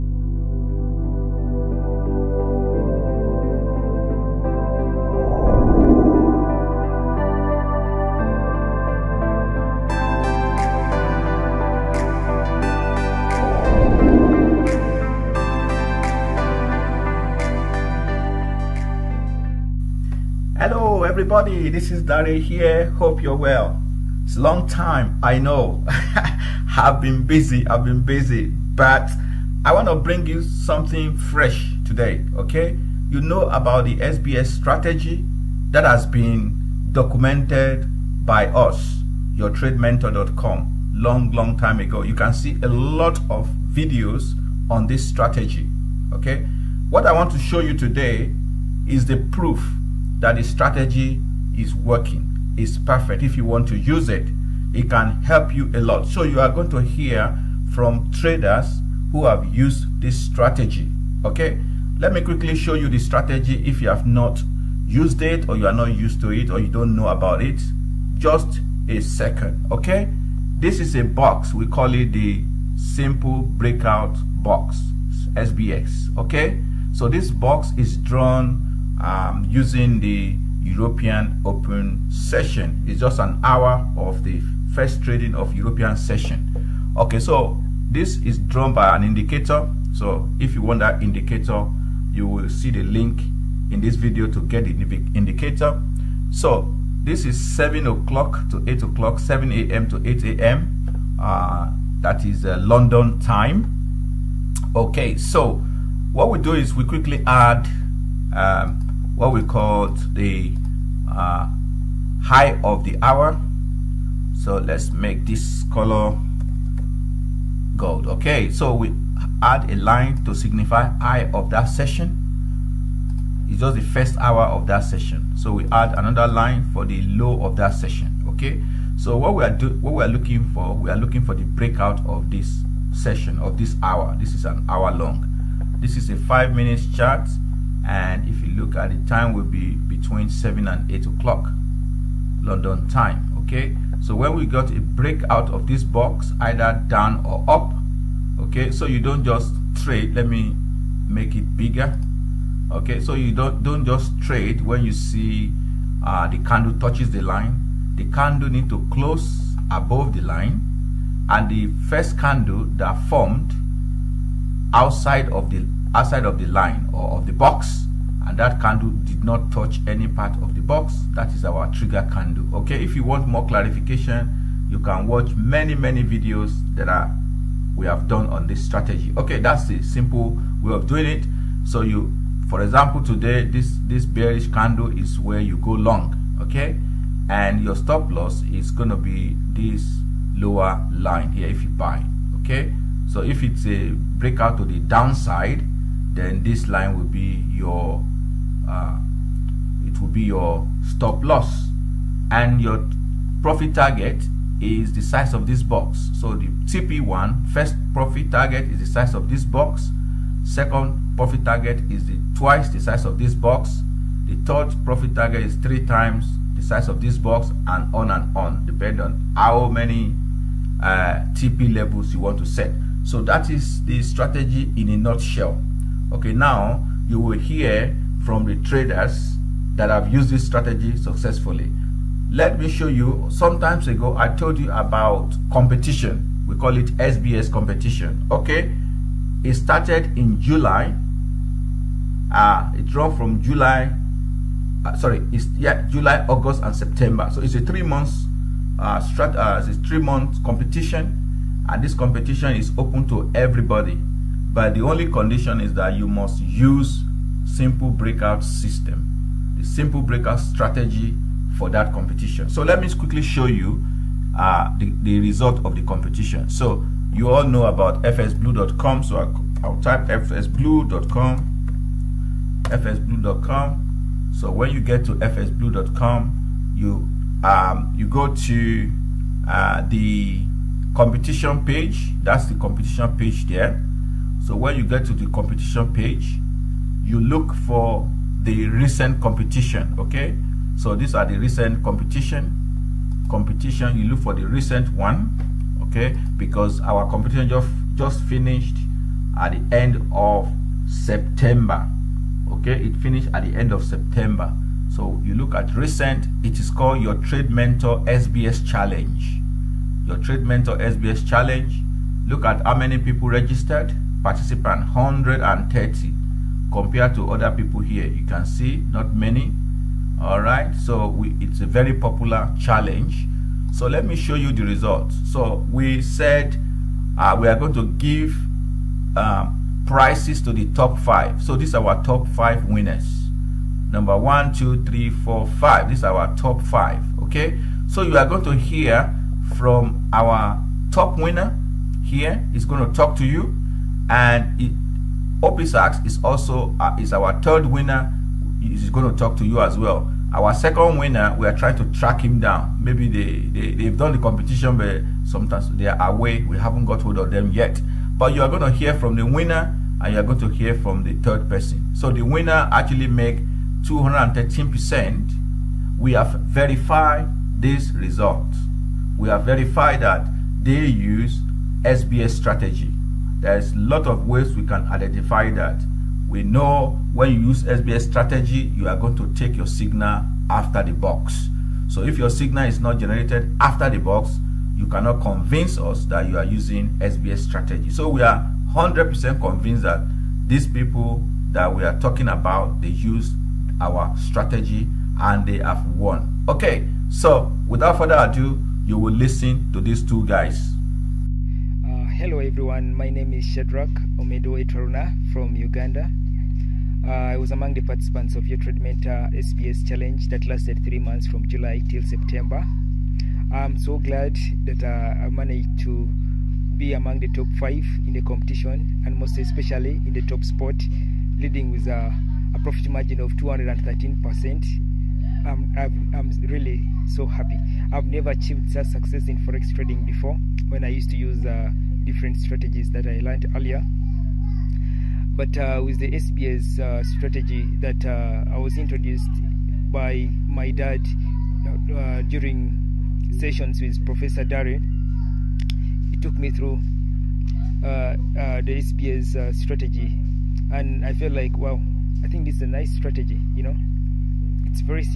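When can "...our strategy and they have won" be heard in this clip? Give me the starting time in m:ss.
6:33.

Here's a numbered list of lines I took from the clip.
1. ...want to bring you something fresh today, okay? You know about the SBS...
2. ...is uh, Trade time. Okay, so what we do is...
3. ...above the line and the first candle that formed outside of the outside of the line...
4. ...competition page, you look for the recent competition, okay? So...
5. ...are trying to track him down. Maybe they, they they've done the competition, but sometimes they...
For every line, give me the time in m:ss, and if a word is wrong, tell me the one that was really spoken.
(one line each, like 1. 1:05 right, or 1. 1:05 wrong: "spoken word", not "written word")
1. 0:29 right
2. 1:42 wrong: "London", not "Trade"
3. 2:39 right
4. 4:45 right
5. 5:51 right.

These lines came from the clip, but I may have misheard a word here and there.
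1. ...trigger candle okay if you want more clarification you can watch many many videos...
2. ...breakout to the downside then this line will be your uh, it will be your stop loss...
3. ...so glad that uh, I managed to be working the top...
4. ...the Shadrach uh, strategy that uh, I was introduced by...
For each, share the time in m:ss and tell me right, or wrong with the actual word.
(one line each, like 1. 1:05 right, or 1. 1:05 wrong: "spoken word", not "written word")
1. 2:51 right
2. 3:14 right
3. 6:53 wrong: "among", not "working"
4. 7:15 wrong: "SBS", not "Shadrach".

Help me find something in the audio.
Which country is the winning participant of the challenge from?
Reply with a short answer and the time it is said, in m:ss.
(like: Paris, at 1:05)
Uganda, at 6:45.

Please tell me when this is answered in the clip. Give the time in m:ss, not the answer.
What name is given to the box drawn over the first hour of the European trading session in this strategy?
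1:12.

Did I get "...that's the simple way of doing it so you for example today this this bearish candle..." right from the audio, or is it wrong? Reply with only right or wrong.
right.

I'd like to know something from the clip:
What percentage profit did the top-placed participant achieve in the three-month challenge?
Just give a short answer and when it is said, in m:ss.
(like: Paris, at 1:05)
213%, at 6:03.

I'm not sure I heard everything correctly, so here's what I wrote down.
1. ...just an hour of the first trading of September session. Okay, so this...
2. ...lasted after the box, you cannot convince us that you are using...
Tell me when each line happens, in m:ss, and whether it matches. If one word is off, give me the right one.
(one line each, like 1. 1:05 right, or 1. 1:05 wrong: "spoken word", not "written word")
1. 1:22 wrong: "European", not "September"
2. 6:22 wrong: "generated", not "lasted".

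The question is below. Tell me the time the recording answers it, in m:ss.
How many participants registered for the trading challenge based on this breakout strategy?
5:14.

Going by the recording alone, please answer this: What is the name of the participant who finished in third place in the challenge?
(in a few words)
Opisax.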